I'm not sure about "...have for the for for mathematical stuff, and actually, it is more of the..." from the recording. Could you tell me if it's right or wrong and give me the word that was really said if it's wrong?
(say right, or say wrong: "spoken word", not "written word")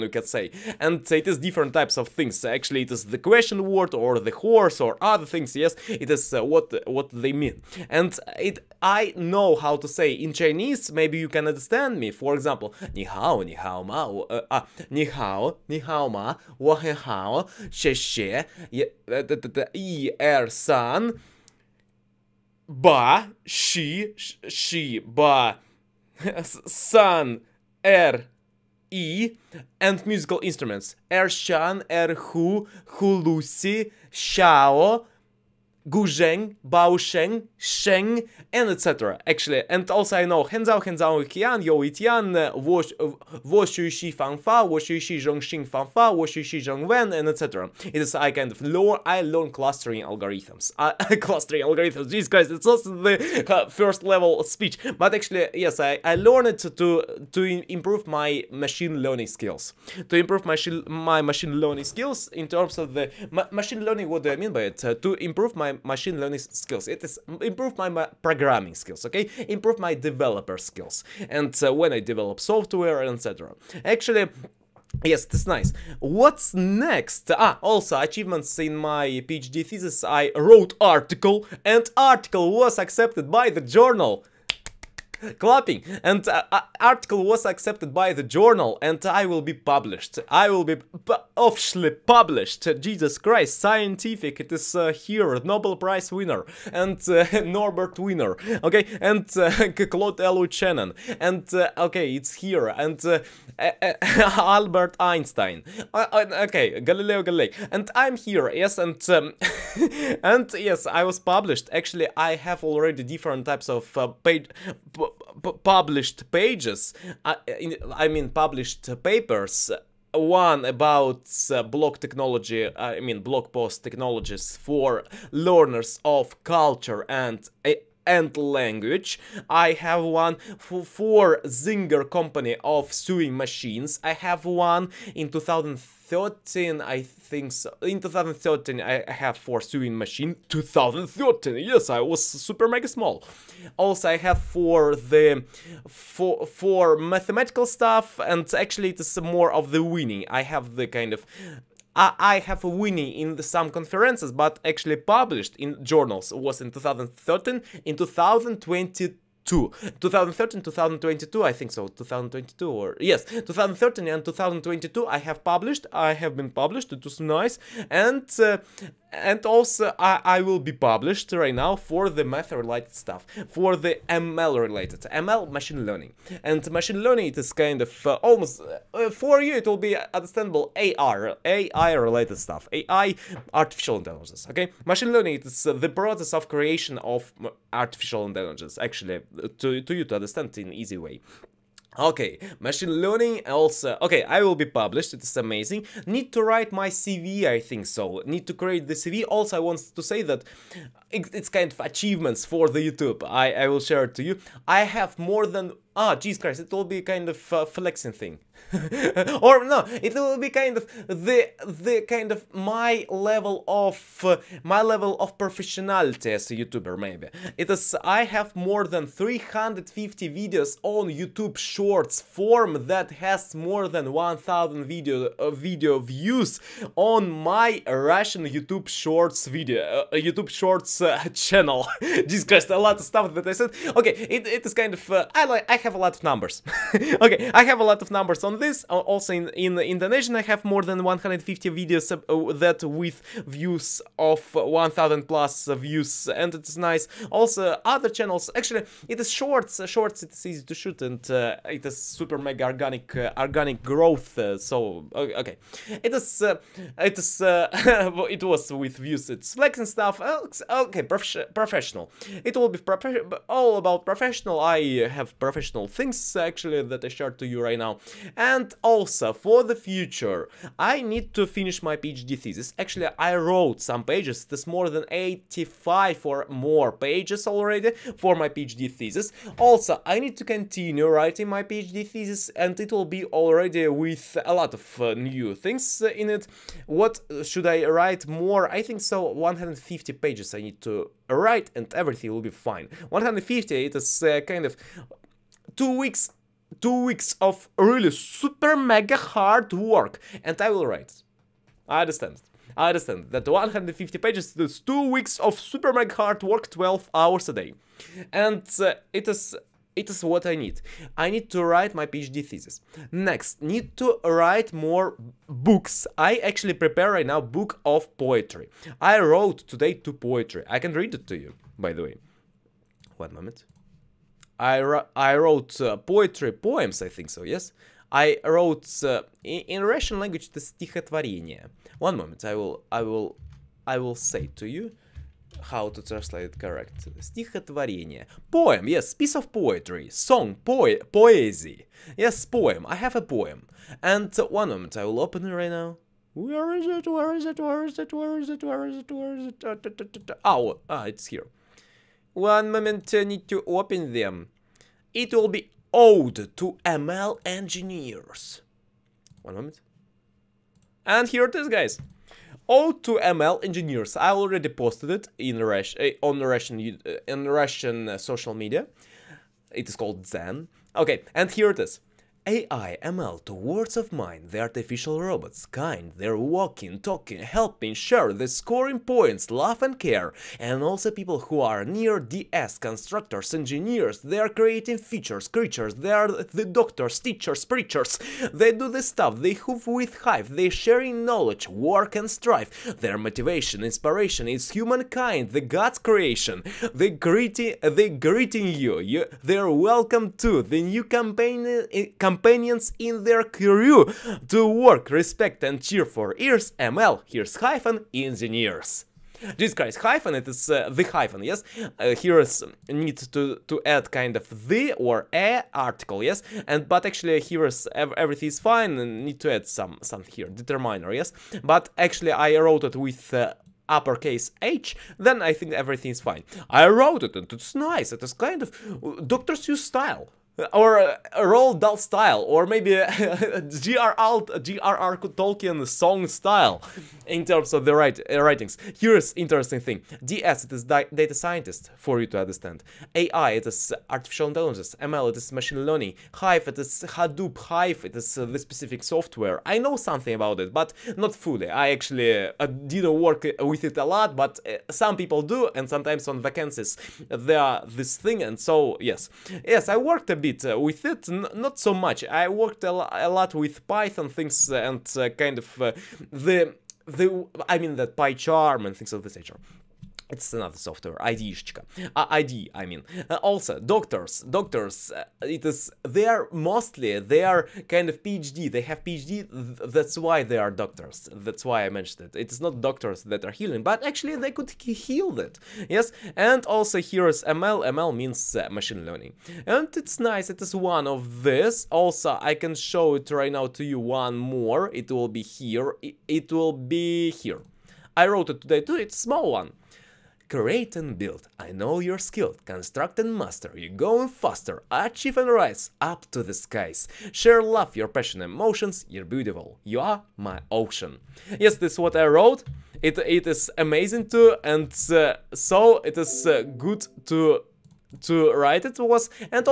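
right.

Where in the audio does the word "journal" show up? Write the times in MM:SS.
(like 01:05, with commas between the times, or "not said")
01:23, 01:28, 02:35.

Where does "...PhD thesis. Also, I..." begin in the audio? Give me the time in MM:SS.
04:38.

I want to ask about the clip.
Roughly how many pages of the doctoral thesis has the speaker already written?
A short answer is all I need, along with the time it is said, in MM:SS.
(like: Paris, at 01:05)
85, at 04:35.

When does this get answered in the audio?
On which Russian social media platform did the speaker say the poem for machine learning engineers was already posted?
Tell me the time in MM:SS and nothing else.
06:10.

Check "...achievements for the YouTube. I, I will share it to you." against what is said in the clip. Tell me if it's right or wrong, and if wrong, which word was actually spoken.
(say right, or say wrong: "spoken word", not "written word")
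right.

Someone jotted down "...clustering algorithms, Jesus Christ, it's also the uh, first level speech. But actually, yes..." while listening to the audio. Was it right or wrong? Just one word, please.
right.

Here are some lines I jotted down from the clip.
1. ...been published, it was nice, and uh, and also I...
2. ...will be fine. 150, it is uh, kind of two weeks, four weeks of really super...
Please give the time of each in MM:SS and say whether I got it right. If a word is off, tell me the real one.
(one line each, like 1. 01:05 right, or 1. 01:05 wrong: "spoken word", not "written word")
1. 02:46 right
2. 04:52 wrong: "two", not "four".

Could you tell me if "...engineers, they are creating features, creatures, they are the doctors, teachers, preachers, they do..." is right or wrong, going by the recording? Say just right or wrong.
right.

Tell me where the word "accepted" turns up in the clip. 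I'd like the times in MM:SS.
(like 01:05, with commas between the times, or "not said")
01:22, 01:27.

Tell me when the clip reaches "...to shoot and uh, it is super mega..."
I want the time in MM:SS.
04:10.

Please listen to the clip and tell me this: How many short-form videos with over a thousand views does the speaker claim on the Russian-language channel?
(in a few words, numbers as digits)
350.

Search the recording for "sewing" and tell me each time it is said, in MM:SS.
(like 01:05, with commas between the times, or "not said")
02:12, 02:19.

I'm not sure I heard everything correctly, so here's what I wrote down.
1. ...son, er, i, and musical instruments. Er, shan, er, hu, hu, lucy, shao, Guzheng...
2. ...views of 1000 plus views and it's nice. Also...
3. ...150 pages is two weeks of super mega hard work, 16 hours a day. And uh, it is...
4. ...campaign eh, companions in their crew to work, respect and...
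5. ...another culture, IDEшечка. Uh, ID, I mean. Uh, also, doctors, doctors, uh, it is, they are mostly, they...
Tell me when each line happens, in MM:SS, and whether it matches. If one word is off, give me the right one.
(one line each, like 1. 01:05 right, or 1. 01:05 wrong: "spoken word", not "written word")
1. 00:26 right
2. 04:03 right
3. 05:03 wrong: "12", not "16"
4. 06:42 right
5. 07:50 wrong: "software", not "culture".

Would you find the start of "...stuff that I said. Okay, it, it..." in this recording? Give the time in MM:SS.
03:53.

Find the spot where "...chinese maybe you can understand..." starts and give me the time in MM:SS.
00:10.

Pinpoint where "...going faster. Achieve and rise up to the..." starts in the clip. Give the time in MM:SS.
08:23.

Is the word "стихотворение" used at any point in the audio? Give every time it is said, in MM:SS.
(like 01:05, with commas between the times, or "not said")
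05:30, 05:37.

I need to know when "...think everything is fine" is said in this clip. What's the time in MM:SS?
07:05.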